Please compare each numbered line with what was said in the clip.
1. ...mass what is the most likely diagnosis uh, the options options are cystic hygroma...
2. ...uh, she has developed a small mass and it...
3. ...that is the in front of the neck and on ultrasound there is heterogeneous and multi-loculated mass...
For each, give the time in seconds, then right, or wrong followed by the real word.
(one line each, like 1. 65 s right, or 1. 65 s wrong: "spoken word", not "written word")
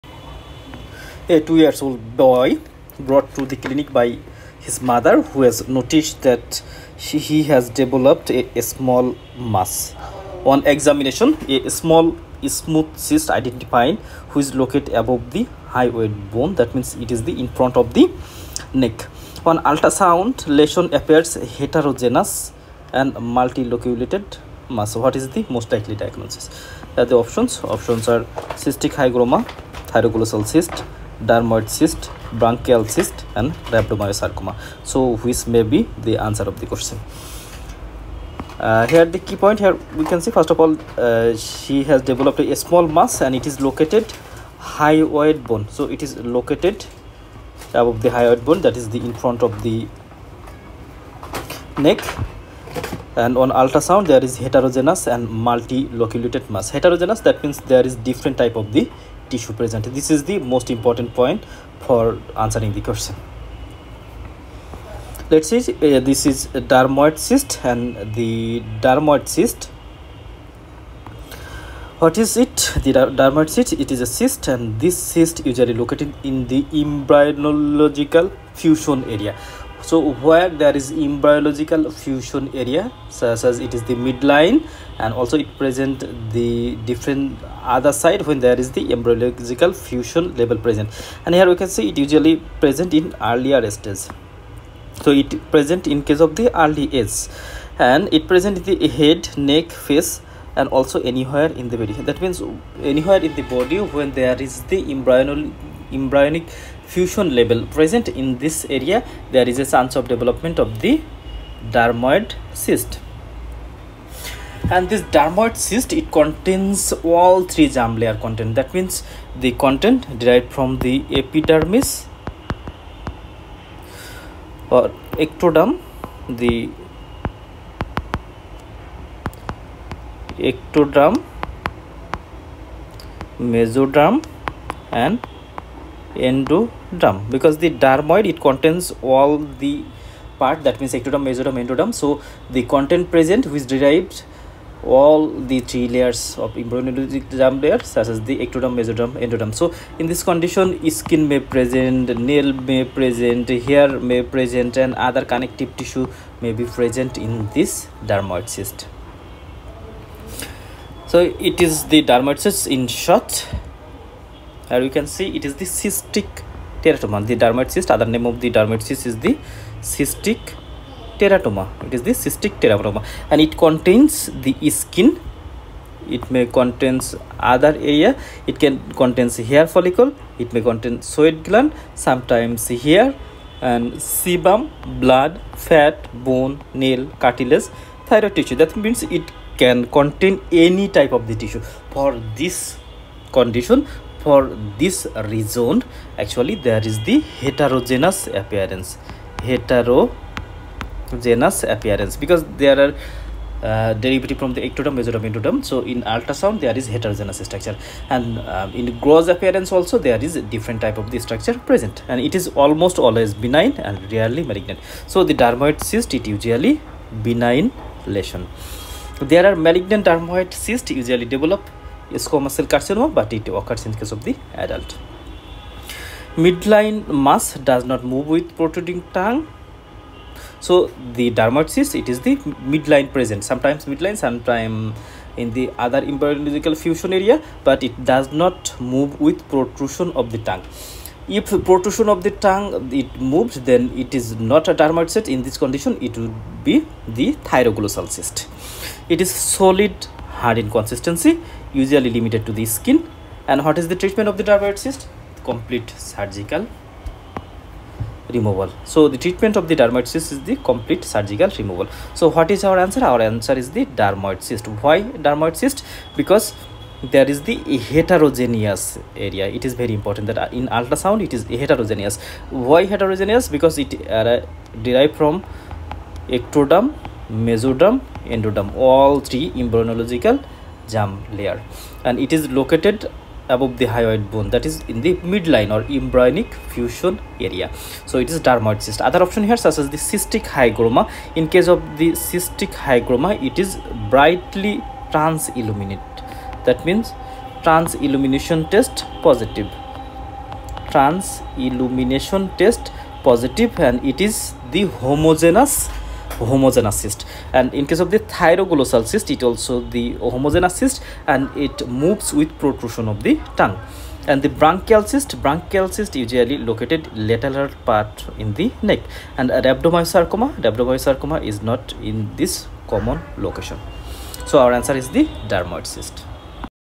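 1. 24 s right
2. 40 s right
3. 48 s right.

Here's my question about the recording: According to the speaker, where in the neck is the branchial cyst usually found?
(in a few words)
Lateral part.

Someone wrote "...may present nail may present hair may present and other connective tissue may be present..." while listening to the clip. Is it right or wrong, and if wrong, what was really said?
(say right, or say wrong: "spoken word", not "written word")
right.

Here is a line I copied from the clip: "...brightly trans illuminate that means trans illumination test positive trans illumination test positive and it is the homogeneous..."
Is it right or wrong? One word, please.
right.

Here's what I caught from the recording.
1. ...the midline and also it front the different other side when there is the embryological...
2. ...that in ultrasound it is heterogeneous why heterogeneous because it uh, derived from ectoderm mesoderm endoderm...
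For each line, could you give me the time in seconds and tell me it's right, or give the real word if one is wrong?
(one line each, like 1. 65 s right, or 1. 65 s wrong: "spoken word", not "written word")
1. 83 s wrong: "present", not "front"
2. 270 s right.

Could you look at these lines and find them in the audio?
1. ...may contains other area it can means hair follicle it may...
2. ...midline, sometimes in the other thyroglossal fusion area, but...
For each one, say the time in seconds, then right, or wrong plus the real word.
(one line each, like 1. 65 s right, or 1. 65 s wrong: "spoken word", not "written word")
1. 176 s wrong: "contains", not "means"
2. 233 s wrong: "embryological", not "thyroglossal".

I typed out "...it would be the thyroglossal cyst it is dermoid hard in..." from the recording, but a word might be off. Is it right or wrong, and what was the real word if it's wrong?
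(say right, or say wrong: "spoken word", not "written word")
wrong: "solid", not "dermoid".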